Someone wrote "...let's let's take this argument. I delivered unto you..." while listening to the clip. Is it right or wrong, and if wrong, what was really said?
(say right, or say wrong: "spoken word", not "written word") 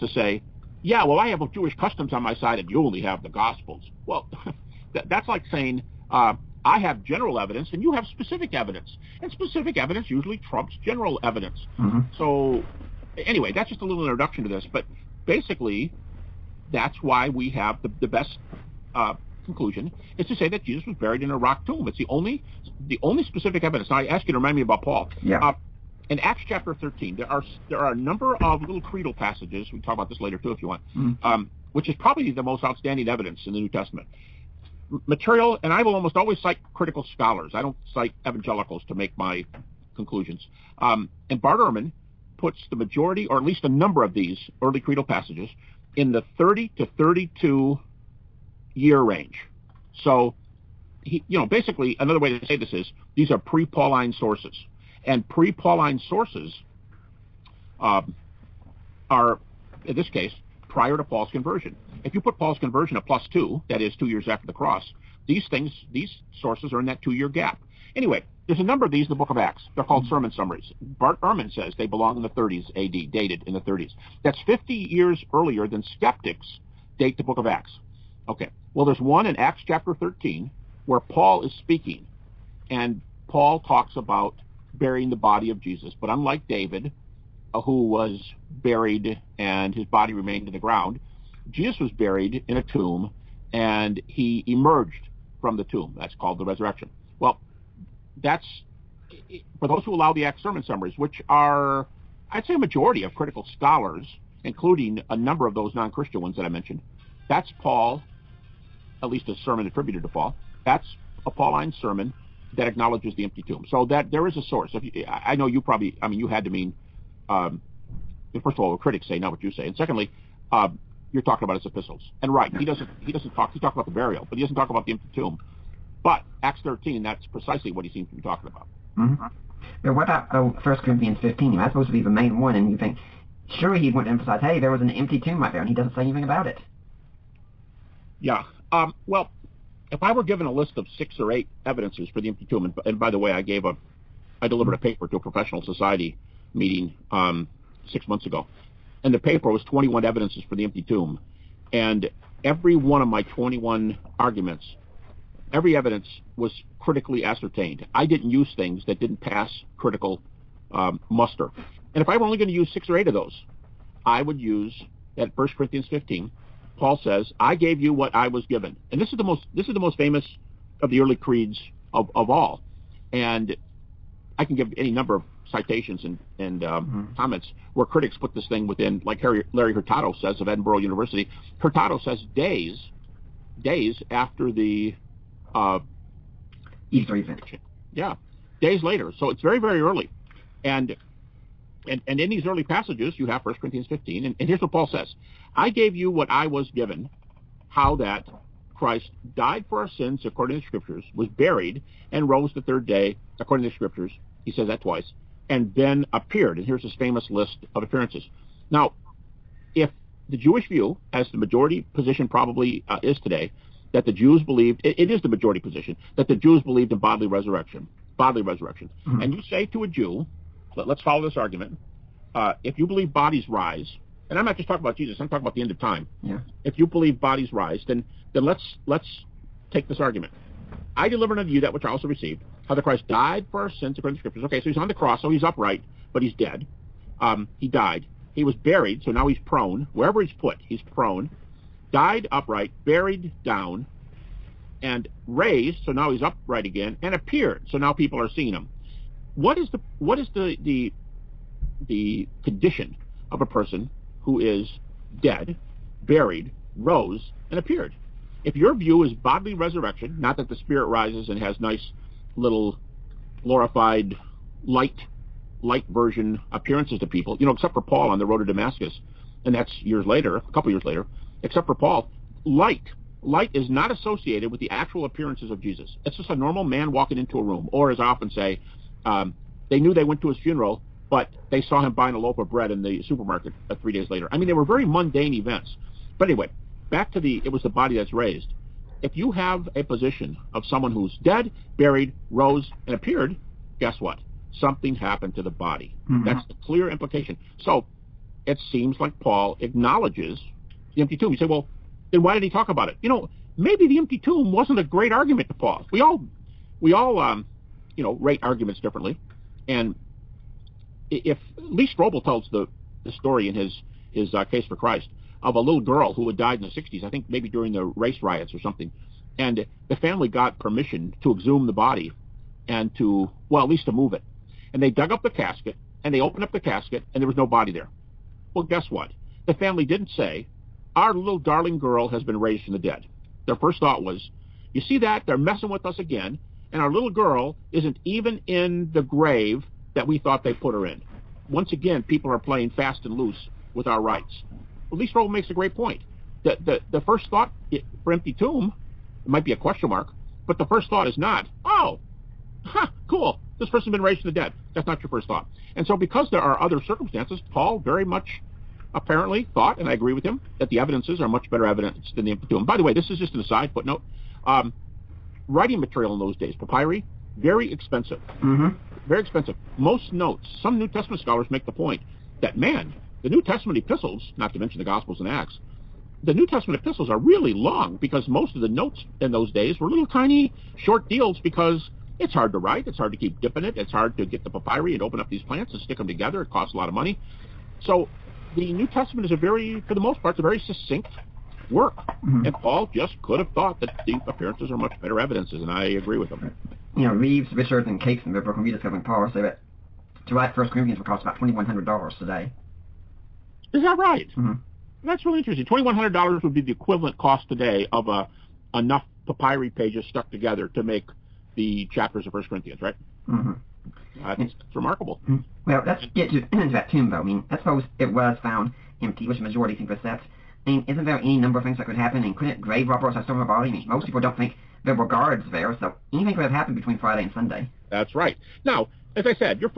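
right.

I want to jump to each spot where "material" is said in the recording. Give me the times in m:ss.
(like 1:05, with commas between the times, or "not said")
0:35, 6:05.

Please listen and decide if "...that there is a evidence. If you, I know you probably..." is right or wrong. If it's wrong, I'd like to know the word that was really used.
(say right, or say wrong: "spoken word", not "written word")
wrong: "source", not "evidence".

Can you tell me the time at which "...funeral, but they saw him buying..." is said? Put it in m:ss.
4:40.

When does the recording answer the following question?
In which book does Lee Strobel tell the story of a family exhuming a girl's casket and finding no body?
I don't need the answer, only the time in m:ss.
5:14.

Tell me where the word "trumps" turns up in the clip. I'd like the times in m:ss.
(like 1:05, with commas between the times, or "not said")
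0:10.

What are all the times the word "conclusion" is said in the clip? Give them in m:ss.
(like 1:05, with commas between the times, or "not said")
0:19, 0:39.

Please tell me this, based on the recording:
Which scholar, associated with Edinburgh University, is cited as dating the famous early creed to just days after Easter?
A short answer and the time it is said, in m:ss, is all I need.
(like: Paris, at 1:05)
Larry Hurtado, at 2:59.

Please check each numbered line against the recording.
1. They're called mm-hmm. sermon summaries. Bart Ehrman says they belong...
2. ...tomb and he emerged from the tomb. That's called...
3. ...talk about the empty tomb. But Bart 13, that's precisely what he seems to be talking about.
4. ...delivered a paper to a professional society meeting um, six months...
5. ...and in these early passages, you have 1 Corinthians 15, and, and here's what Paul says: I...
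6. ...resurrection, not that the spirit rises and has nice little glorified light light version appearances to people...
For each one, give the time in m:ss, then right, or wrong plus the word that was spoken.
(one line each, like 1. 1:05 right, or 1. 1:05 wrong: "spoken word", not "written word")
1. 1:09 right
2. 1:32 right
3. 2:04 wrong: "Acts", not "Bart"
4. 2:24 right
5. 3:12 right
6. 4:19 right.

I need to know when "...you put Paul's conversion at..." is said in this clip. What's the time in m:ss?
1:02.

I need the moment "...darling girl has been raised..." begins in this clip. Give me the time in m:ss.
5:31.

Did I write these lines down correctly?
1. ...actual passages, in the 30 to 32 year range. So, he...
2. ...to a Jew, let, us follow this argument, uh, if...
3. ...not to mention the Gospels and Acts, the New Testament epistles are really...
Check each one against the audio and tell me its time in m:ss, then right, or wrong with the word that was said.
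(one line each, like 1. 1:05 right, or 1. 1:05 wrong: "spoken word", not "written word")
1. 0:44 wrong: "creedal", not "actual"
2. 3:39 right
3. 6:14 right.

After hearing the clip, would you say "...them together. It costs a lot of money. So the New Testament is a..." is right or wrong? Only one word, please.
right.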